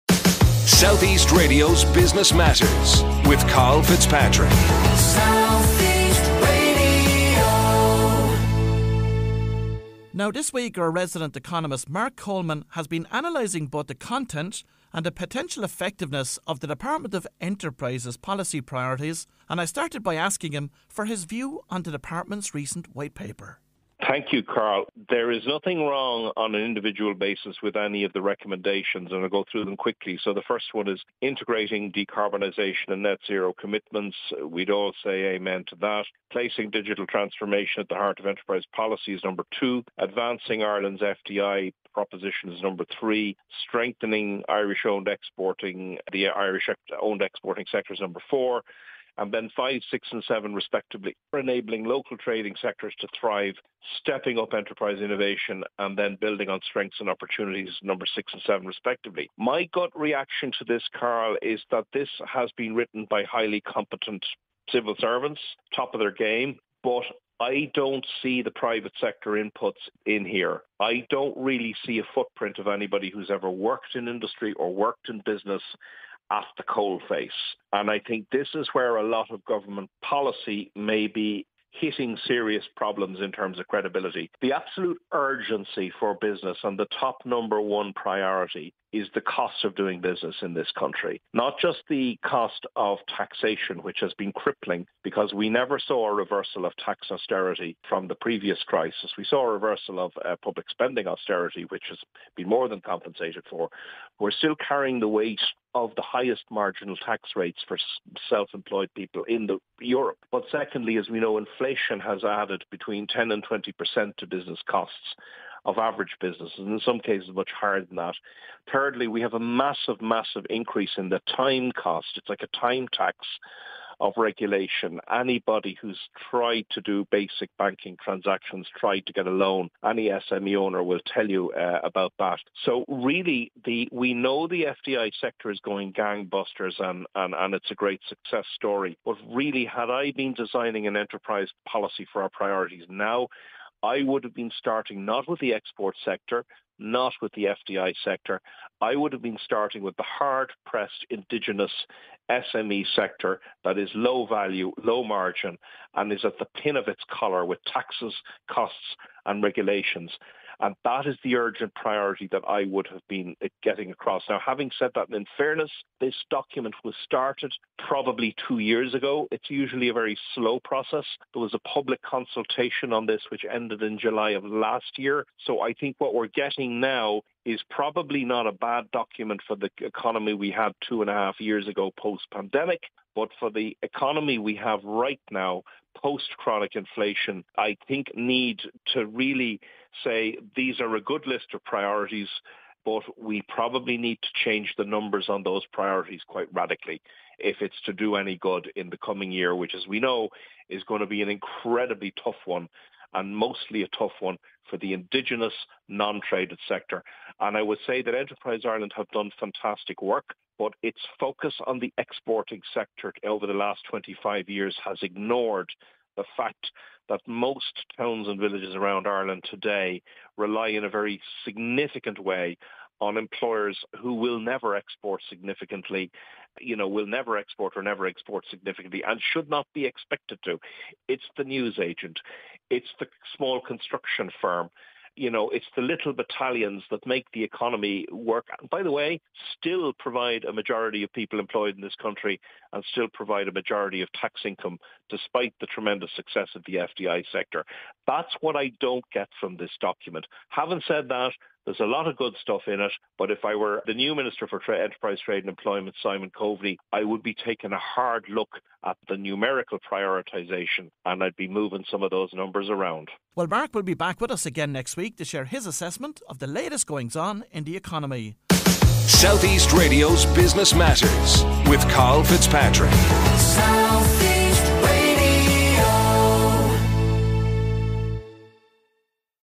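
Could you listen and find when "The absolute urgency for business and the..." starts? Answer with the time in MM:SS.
01:24.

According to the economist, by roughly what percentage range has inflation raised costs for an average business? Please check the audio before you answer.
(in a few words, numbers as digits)
10 to 20 percent.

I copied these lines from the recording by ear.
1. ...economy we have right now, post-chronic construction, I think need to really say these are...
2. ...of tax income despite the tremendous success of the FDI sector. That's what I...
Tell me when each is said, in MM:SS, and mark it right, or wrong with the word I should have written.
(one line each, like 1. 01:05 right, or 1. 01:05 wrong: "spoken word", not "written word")
1. 03:03 wrong: "inflation", not "construction"
2. 04:04 right.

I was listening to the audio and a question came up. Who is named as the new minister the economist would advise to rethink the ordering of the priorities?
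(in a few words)
Simon Coveney.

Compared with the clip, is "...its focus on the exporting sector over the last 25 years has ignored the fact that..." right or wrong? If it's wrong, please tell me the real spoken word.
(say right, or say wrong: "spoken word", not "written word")
right.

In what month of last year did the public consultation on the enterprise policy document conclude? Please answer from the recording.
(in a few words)
July.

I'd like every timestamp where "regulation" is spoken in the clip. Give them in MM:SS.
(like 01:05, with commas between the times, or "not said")
02:04, 02:39.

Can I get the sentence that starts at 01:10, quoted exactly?
I don't really see a footprint of anybody who's ever worked in industry or worked in business at the coalface.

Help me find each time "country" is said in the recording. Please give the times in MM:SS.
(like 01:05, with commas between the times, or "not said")
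01:30, 04:02.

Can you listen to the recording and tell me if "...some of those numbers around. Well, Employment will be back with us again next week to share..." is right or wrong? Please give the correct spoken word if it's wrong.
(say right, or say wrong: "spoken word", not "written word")
wrong: "Marc", not "Employment".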